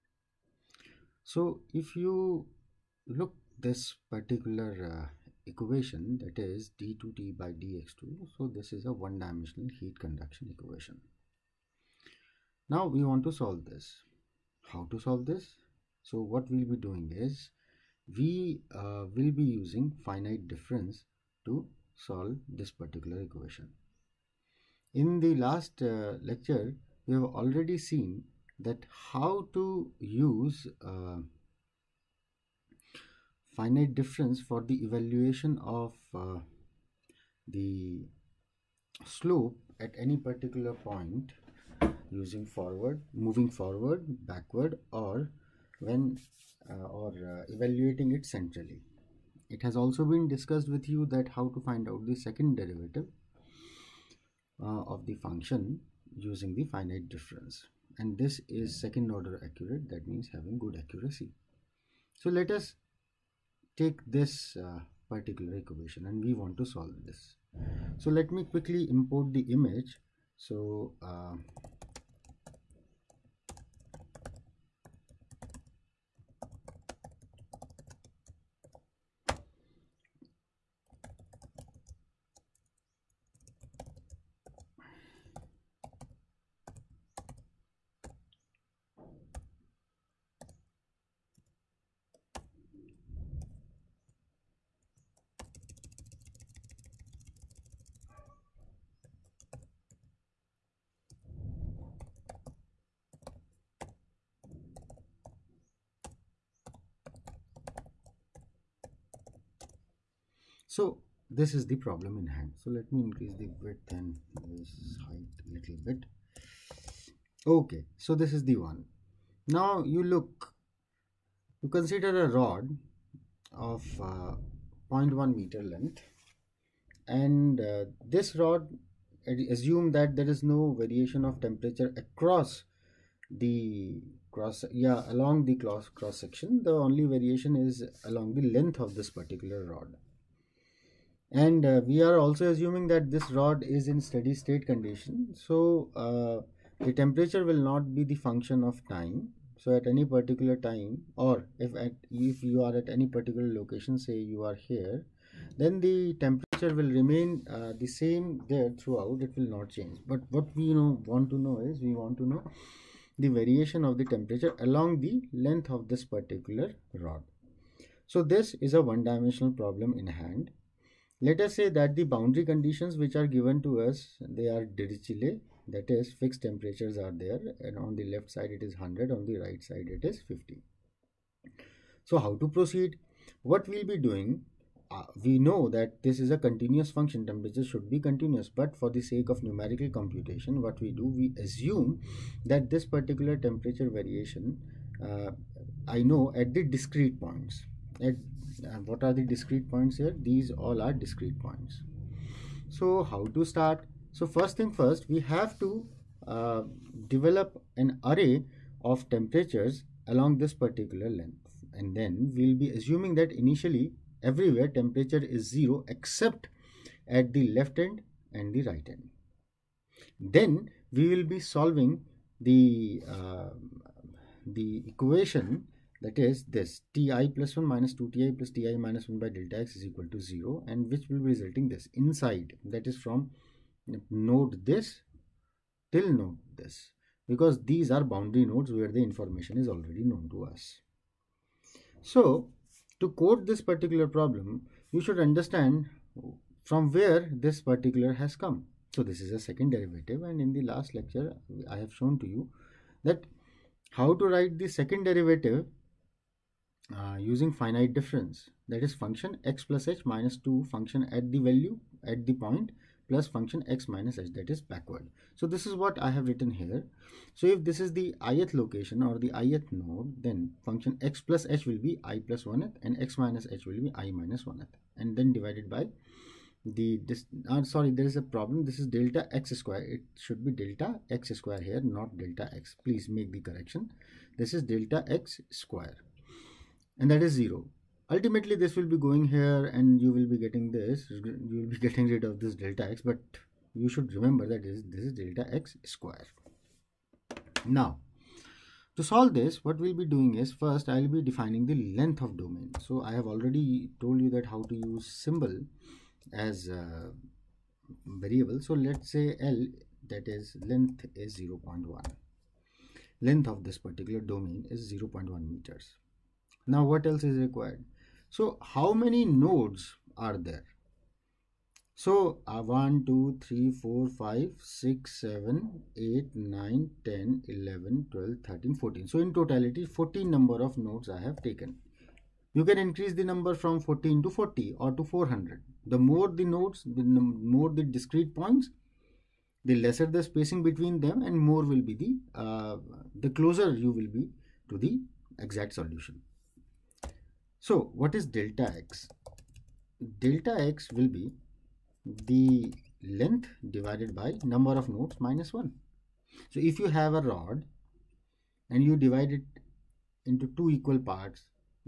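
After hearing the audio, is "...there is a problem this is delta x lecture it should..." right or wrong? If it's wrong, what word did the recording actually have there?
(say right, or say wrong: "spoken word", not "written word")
wrong: "square", not "lecture".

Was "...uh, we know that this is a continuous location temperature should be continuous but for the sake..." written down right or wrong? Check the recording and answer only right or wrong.
wrong.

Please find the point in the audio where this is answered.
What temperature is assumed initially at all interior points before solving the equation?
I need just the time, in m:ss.
3:35.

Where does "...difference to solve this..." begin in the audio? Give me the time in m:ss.
0:20.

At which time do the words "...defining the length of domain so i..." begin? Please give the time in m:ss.
5:01.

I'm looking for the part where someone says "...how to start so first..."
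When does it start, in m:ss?
3:23.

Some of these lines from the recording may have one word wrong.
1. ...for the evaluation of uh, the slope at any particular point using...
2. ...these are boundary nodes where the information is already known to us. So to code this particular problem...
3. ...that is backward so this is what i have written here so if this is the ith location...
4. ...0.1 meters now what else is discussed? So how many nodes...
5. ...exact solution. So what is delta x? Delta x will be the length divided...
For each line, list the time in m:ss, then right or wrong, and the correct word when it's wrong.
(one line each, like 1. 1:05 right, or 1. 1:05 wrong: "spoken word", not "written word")
1. 0:34 right
2. 3:57 right
3. 4:24 right
4. 5:14 wrong: "required", not "discussed"
5. 5:45 right.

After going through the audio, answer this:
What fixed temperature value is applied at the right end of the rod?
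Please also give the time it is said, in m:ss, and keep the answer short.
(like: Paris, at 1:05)
50, at 3:00.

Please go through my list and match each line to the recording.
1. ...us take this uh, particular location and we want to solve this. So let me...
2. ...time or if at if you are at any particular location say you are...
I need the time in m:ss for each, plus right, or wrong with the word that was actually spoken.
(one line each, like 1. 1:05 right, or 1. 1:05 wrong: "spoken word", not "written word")
1. 1:02 wrong: "equation", not "location"
2. 2:30 right.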